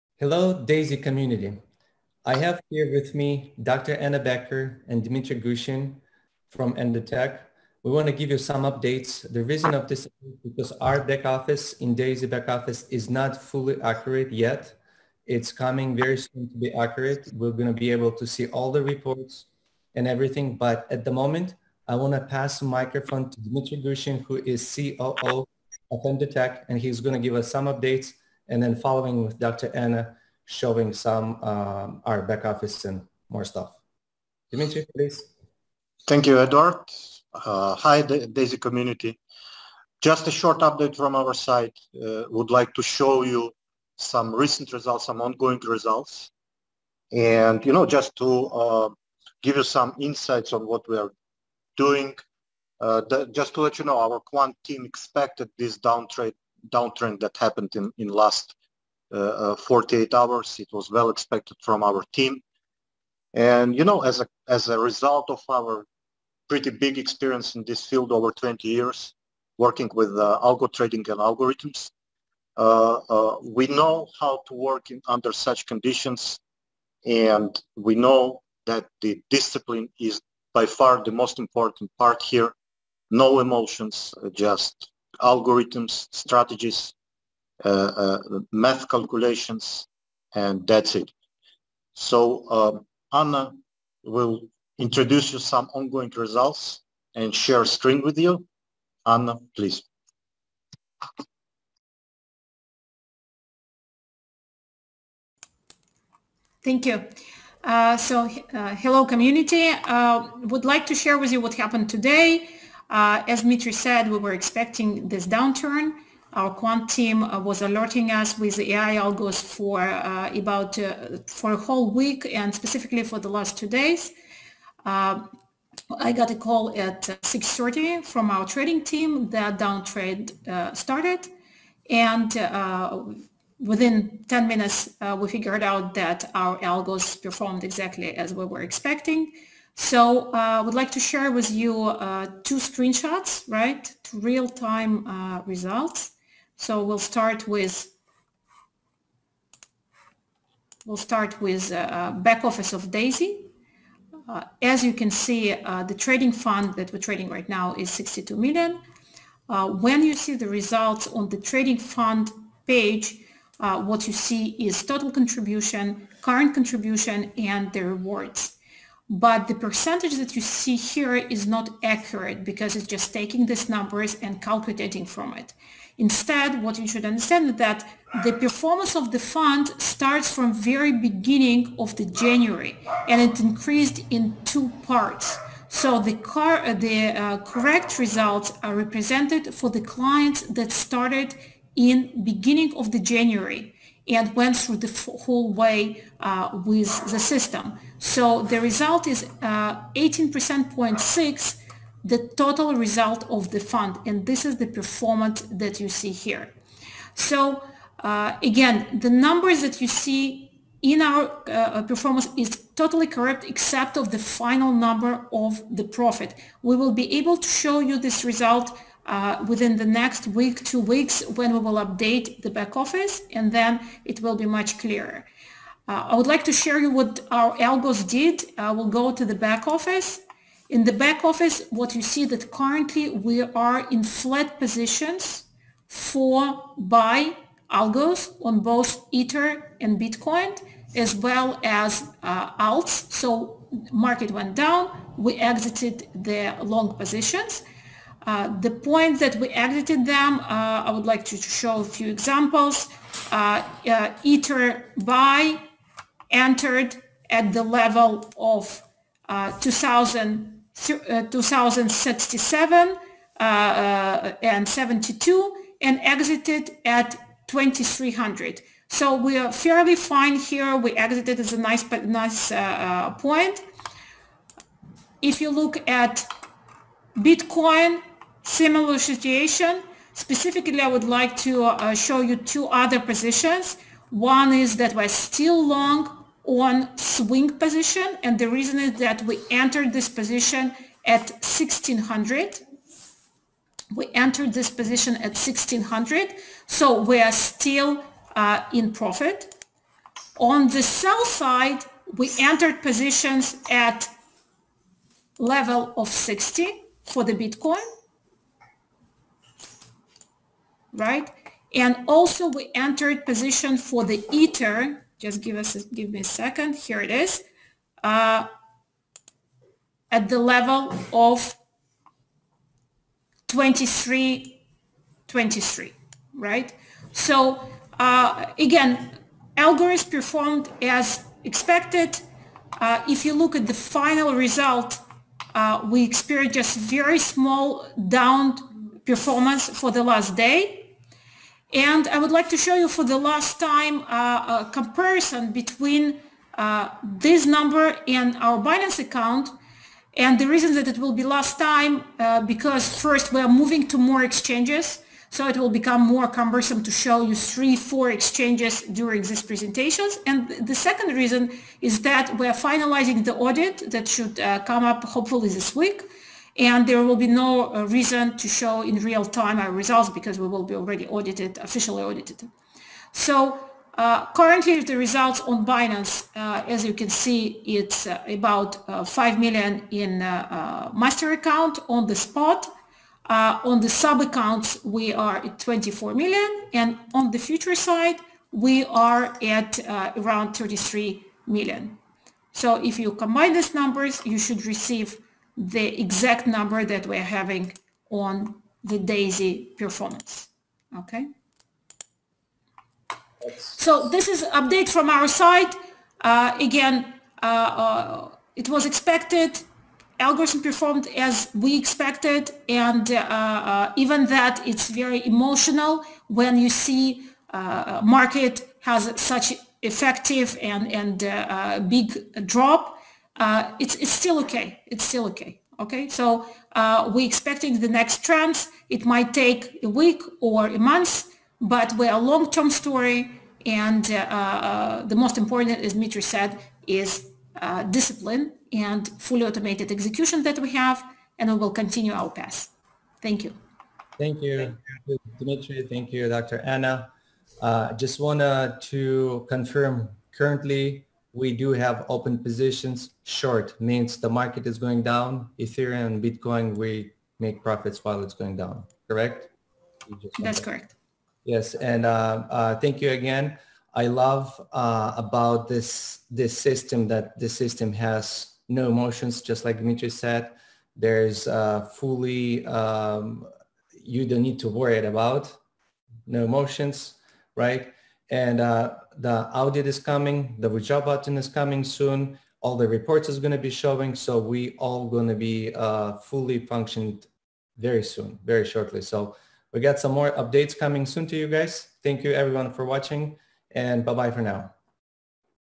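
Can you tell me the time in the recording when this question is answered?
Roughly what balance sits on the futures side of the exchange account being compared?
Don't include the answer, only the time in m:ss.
6:30.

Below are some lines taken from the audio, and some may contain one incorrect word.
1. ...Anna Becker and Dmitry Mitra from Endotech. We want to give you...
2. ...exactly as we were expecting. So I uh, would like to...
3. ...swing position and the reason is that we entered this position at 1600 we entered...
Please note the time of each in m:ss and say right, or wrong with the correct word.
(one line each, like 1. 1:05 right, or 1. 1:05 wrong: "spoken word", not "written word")
1. 0:03 wrong: "Gushin", not "Mitra"
2. 2:17 right
3. 4:46 right.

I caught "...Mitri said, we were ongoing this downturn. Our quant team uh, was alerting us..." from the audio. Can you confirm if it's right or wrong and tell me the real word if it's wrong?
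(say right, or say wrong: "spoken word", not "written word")
wrong: "expecting", not "ongoing".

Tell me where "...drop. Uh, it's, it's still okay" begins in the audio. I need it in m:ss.
7:02.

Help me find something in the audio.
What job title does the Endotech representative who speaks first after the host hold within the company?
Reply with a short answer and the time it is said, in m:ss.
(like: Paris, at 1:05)
COO, at 0:24.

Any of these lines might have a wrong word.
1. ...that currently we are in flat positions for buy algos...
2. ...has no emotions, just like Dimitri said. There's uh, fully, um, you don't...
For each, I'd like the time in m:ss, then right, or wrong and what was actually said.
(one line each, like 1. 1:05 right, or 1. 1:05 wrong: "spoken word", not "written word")
1. 3:52 right
2. 7:47 right.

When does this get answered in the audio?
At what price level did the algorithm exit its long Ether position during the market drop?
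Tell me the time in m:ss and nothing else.
4:27.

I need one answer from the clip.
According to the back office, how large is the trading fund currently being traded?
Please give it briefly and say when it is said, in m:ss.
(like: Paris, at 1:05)
62 million, at 2:37.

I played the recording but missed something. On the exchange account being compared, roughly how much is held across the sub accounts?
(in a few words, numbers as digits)
24 million.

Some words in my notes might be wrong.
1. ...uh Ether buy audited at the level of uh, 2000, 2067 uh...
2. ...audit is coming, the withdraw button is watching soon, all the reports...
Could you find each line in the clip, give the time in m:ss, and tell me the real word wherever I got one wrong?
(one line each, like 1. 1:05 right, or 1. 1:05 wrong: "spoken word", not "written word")
1. 4:13 wrong: "entered", not "audited"
2. 7:59 wrong: "coming", not "watching".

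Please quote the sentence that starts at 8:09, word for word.
So we got some more updates coming soon to you guys.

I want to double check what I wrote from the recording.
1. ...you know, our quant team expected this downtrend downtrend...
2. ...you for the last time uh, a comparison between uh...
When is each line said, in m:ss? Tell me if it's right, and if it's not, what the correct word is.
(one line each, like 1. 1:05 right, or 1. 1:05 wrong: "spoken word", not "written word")
1. 0:53 right
2. 5:42 right.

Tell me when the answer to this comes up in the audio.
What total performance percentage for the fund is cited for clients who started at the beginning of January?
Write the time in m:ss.
3:19.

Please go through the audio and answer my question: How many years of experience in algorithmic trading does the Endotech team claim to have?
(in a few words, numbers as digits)
over 20 years.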